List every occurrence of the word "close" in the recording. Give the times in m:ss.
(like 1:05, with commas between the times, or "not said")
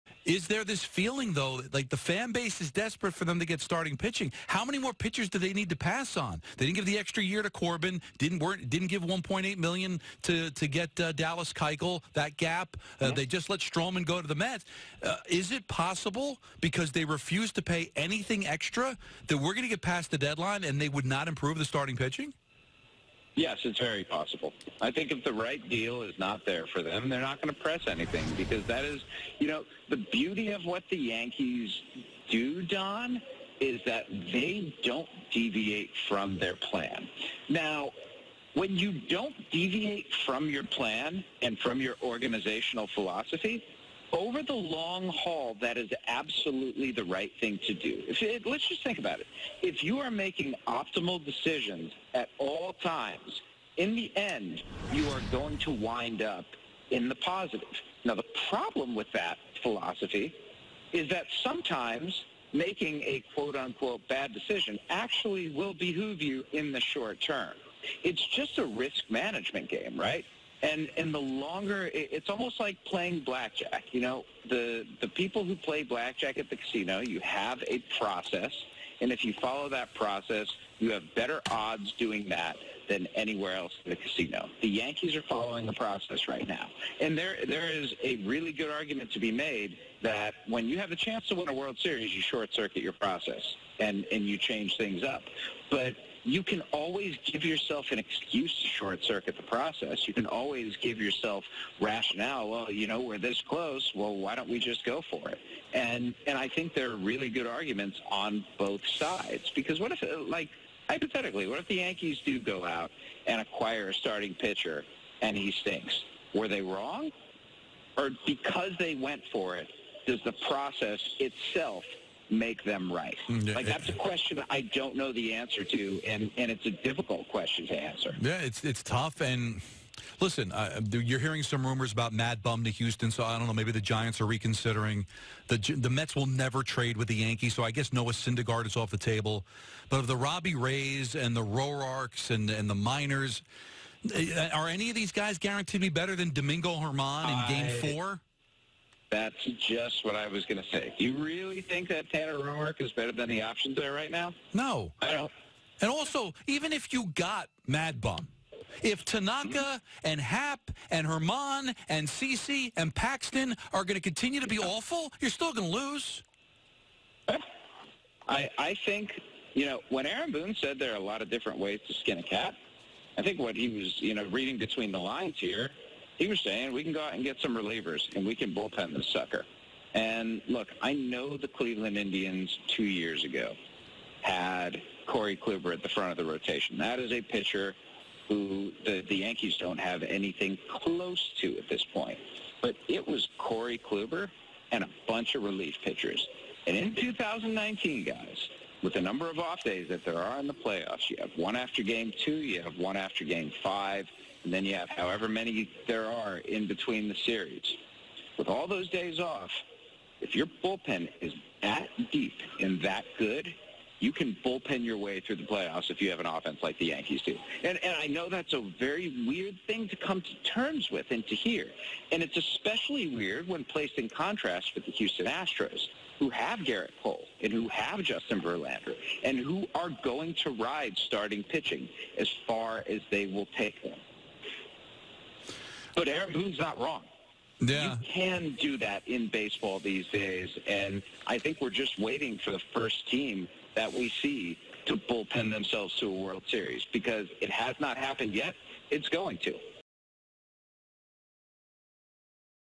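1:43, 3:10.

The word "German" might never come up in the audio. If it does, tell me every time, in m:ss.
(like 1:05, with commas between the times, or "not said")
2:26, 2:41.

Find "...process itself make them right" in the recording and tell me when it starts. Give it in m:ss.
2:00.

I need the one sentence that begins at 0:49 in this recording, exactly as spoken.
If you are making optimal decisions at all times, in the end, you are going to wind up in the positive.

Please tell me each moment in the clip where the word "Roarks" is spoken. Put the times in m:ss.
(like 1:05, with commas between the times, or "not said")
2:21, 2:32.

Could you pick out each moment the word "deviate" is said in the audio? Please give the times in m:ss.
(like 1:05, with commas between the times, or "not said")
0:35, 0:39.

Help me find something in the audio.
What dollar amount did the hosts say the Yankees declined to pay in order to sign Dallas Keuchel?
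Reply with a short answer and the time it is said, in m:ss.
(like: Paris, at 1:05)
1.8 million, at 0:09.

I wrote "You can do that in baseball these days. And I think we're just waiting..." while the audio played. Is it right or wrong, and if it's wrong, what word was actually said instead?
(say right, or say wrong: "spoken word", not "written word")
right.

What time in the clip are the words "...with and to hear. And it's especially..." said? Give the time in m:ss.
3:40.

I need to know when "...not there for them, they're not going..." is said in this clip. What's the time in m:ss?
0:26.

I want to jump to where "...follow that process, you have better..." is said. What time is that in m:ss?
1:19.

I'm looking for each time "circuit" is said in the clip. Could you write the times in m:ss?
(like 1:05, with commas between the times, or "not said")
1:32, 1:39.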